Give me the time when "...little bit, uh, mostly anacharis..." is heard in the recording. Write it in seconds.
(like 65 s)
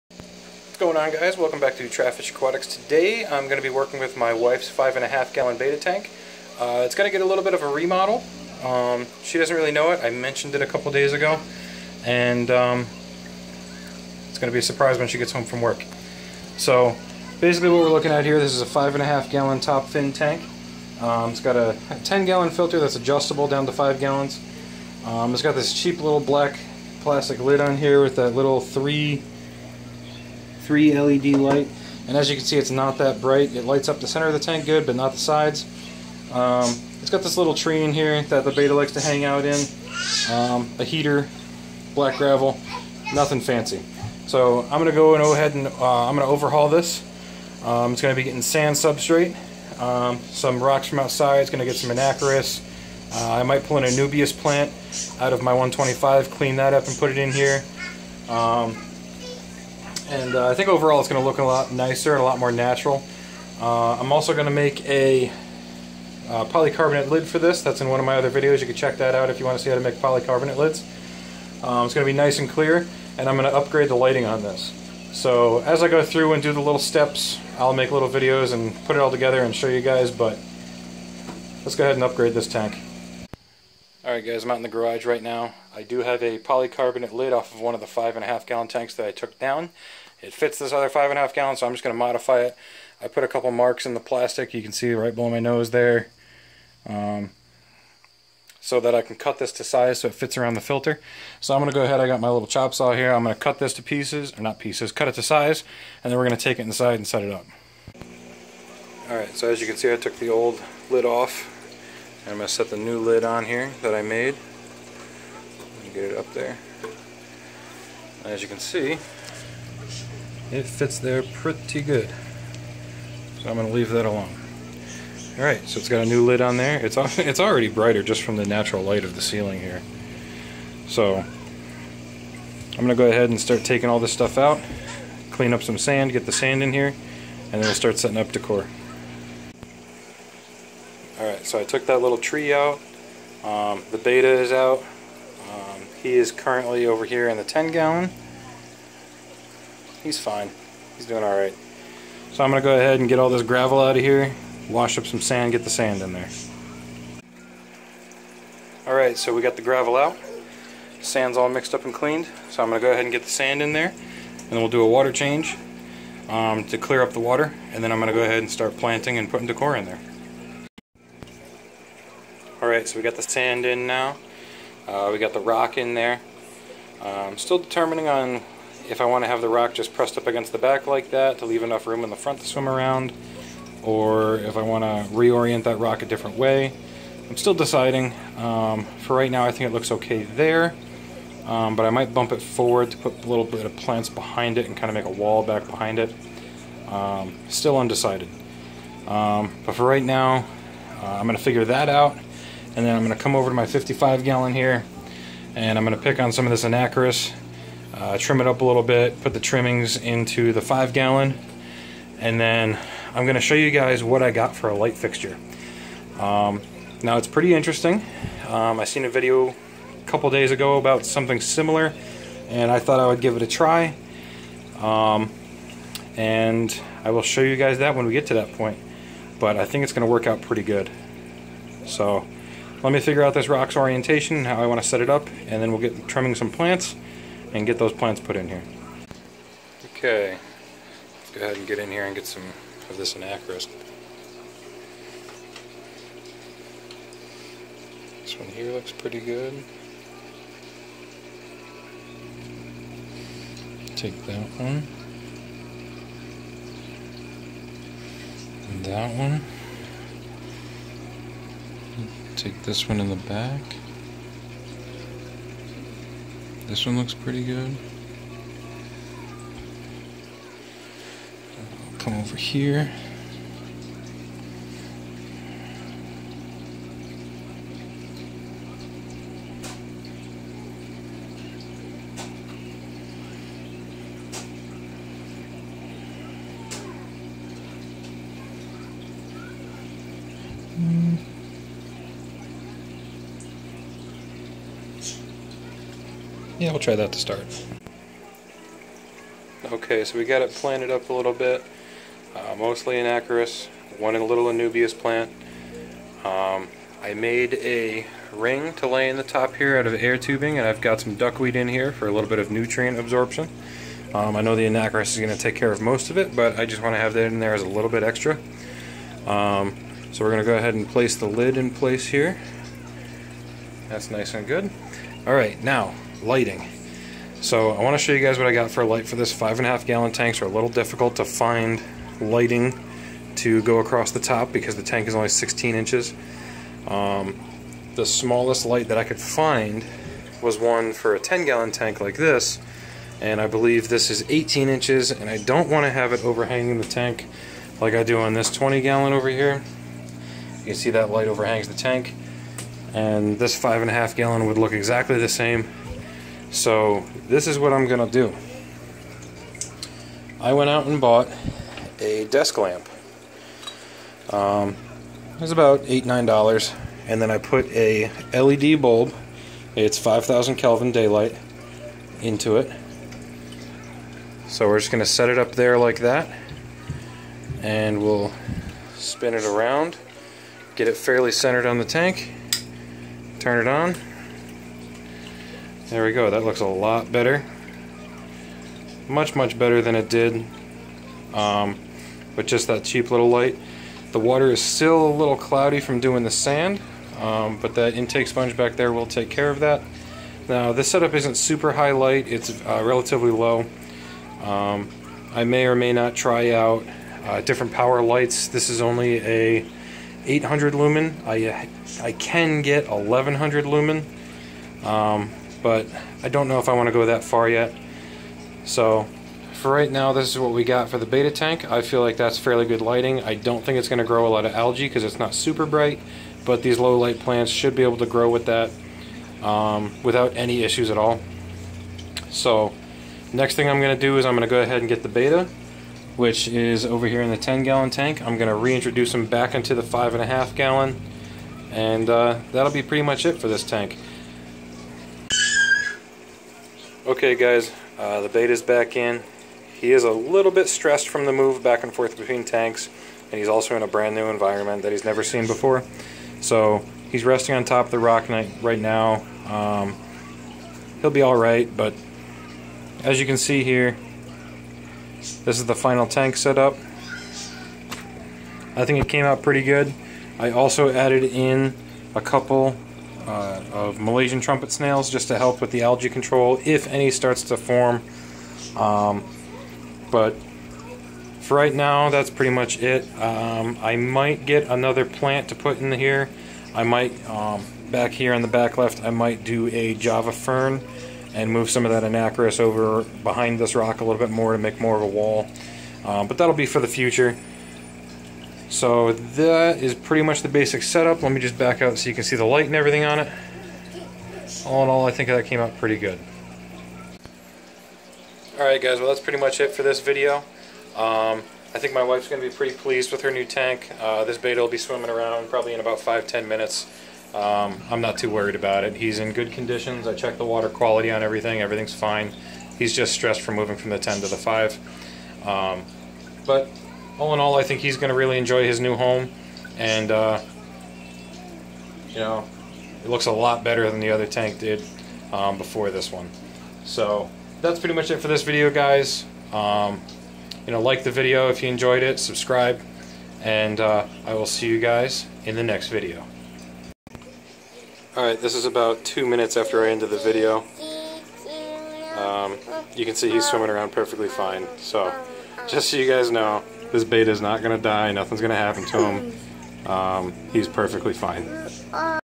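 301 s.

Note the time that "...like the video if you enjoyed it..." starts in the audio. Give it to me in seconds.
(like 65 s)
540 s.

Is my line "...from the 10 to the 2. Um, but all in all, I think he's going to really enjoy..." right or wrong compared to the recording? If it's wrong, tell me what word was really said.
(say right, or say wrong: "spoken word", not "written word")
wrong: "5", not "2".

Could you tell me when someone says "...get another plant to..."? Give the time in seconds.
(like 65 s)
484 s.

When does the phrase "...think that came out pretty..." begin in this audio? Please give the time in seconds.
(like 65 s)
505 s.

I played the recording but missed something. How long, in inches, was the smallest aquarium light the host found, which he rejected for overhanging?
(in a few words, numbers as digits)
18 inches.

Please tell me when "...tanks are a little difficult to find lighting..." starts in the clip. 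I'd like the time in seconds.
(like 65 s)
330 s.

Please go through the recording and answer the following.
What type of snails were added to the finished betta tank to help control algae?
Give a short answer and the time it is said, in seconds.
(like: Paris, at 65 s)
Malaysian trumpet snails, at 473 s.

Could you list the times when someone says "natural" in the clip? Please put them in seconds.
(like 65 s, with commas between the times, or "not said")
62 s, 128 s.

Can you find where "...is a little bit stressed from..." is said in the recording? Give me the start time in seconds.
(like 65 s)
449 s.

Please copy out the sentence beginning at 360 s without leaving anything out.
I went out and bought a desk lamp.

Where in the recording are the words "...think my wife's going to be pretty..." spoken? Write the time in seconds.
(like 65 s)
511 s.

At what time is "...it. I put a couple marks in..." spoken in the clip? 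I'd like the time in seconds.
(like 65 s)
92 s.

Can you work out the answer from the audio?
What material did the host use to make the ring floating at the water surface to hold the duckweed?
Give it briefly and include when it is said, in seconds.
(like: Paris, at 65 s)
air tubing, at 309 s.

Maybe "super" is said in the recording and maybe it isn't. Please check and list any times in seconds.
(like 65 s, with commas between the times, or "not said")
401 s, 425 s.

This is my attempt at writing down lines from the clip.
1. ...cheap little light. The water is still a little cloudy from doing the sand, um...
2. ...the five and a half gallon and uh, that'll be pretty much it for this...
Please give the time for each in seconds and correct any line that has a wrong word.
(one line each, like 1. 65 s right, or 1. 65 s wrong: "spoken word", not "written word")
1. 392 s right
2. 439 s right.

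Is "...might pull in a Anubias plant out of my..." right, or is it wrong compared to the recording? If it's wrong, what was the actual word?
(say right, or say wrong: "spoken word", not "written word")
right.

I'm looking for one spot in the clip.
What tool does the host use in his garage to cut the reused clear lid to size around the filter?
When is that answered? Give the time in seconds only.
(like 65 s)
102 s.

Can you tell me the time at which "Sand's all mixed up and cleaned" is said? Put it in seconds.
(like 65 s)
161 s.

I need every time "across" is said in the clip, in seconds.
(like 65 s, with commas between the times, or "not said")
333 s.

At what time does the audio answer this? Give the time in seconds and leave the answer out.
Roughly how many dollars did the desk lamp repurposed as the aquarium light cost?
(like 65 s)
365 s.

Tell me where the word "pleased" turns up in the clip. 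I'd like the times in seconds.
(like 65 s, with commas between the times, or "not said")
512 s.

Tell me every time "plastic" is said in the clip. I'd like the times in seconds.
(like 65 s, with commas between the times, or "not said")
27 s, 93 s.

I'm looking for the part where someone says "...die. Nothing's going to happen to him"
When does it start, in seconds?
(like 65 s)
557 s.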